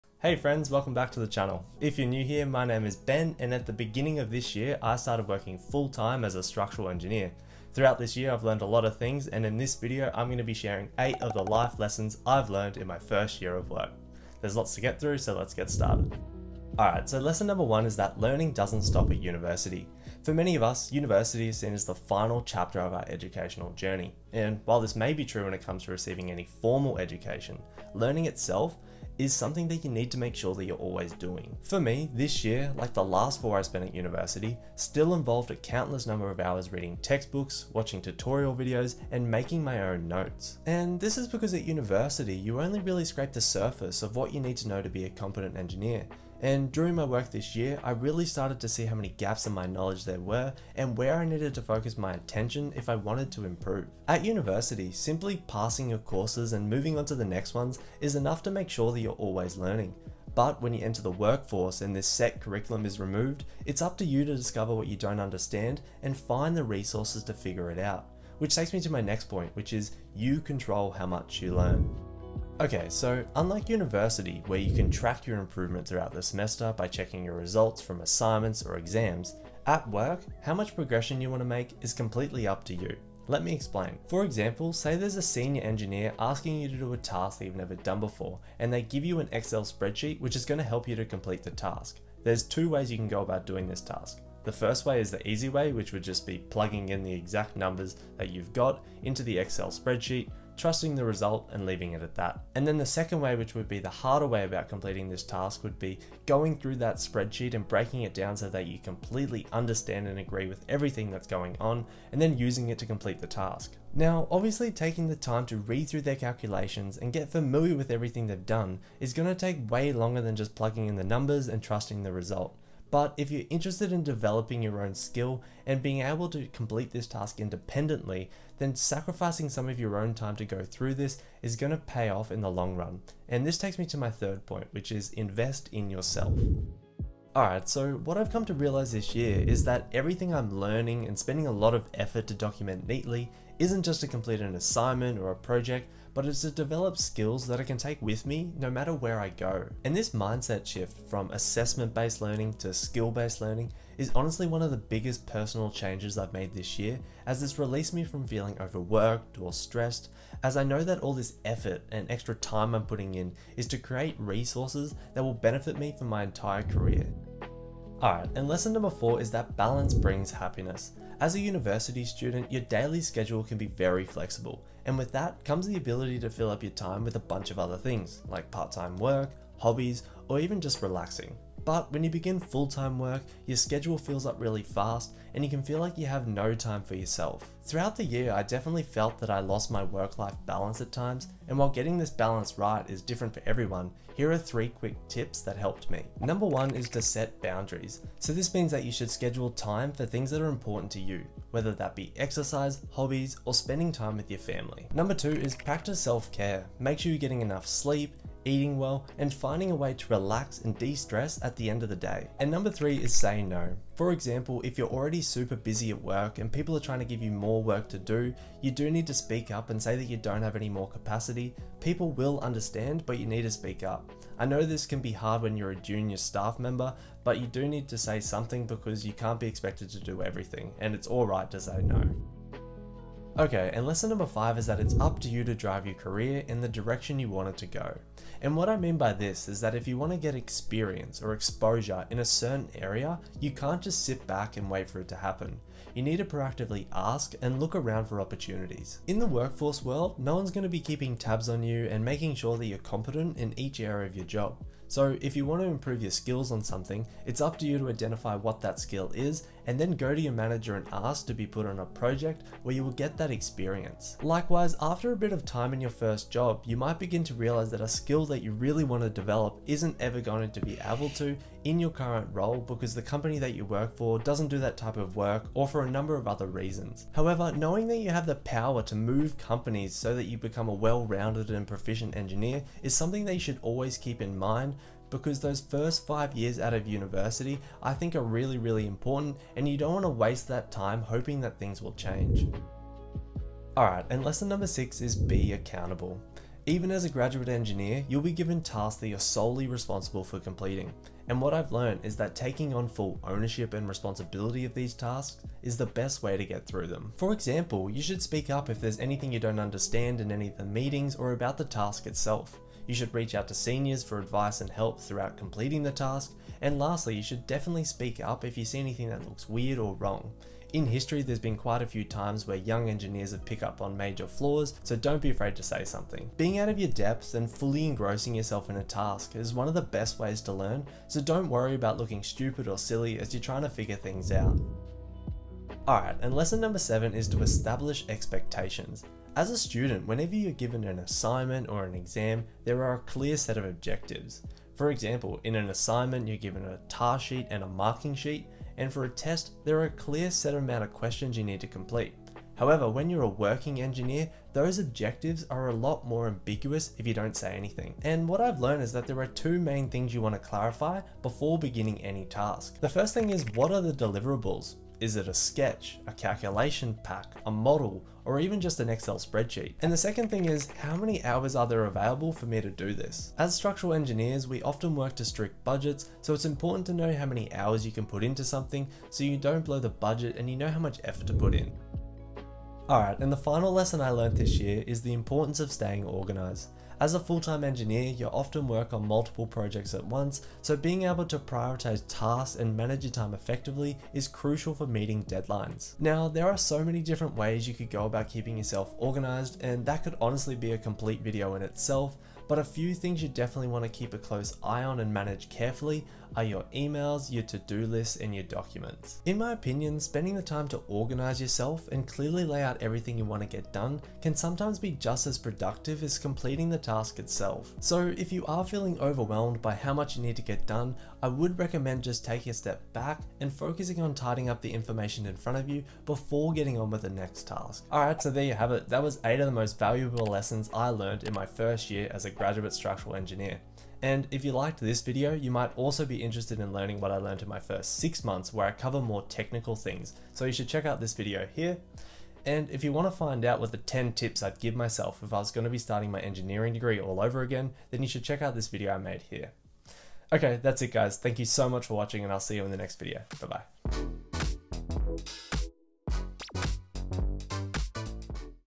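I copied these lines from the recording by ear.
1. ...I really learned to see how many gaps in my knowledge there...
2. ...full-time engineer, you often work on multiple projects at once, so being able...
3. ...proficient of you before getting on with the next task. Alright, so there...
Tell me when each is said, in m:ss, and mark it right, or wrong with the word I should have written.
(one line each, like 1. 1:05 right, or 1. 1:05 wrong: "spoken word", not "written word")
1. 0:47 wrong: "started", not "learned"
2. 6:27 right
3. 7:05 wrong: "front", not "proficient".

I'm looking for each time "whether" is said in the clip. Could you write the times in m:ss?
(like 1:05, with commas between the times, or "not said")
3:21.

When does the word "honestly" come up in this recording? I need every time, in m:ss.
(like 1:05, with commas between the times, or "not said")
2:34, 6:40.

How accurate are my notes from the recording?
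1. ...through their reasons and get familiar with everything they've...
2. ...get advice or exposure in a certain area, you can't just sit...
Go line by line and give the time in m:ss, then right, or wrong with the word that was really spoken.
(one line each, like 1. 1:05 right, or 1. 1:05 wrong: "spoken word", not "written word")
1. 1:55 wrong: "calculations", not "reasons"
2. 4:00 wrong: "experience", not "advice".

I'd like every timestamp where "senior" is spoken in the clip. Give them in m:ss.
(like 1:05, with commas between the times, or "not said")
1:25, 5:13.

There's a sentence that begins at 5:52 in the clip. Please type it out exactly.
However, when you're a working engineer, those objectives are a lot more ambiguous if you don't say anything.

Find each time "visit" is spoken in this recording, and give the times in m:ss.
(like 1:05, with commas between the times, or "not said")
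not said.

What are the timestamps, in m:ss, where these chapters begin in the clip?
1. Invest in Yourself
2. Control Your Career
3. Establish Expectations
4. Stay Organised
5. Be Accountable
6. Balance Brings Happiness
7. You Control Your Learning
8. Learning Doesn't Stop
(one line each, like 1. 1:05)
1. 2:16
2. 3:52
3. 5:34
4. 6:21
5. 4:52
6. 2:47
7. 1:11
8. 0:16.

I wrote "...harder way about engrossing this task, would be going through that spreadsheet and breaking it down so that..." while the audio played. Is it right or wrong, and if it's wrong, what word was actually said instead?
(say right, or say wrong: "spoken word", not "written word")
wrong: "completing", not "engrossing".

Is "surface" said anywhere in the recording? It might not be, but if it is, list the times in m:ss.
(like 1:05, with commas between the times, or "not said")
0:43.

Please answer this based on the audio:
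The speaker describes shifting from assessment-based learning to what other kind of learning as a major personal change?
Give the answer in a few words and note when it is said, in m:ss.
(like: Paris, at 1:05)
skill-based learning, at 2:32.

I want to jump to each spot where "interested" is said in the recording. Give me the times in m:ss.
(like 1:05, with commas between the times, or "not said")
2:03, 7:16.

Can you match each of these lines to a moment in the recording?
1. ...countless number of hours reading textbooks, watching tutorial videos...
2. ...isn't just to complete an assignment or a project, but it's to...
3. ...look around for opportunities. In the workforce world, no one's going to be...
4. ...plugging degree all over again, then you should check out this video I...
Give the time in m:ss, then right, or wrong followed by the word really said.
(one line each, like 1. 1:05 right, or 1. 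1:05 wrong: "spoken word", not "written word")
1. 0:35 right
2. 2:23 right
3. 4:07 right
4. 7:26 wrong: "engineering", not "plugging".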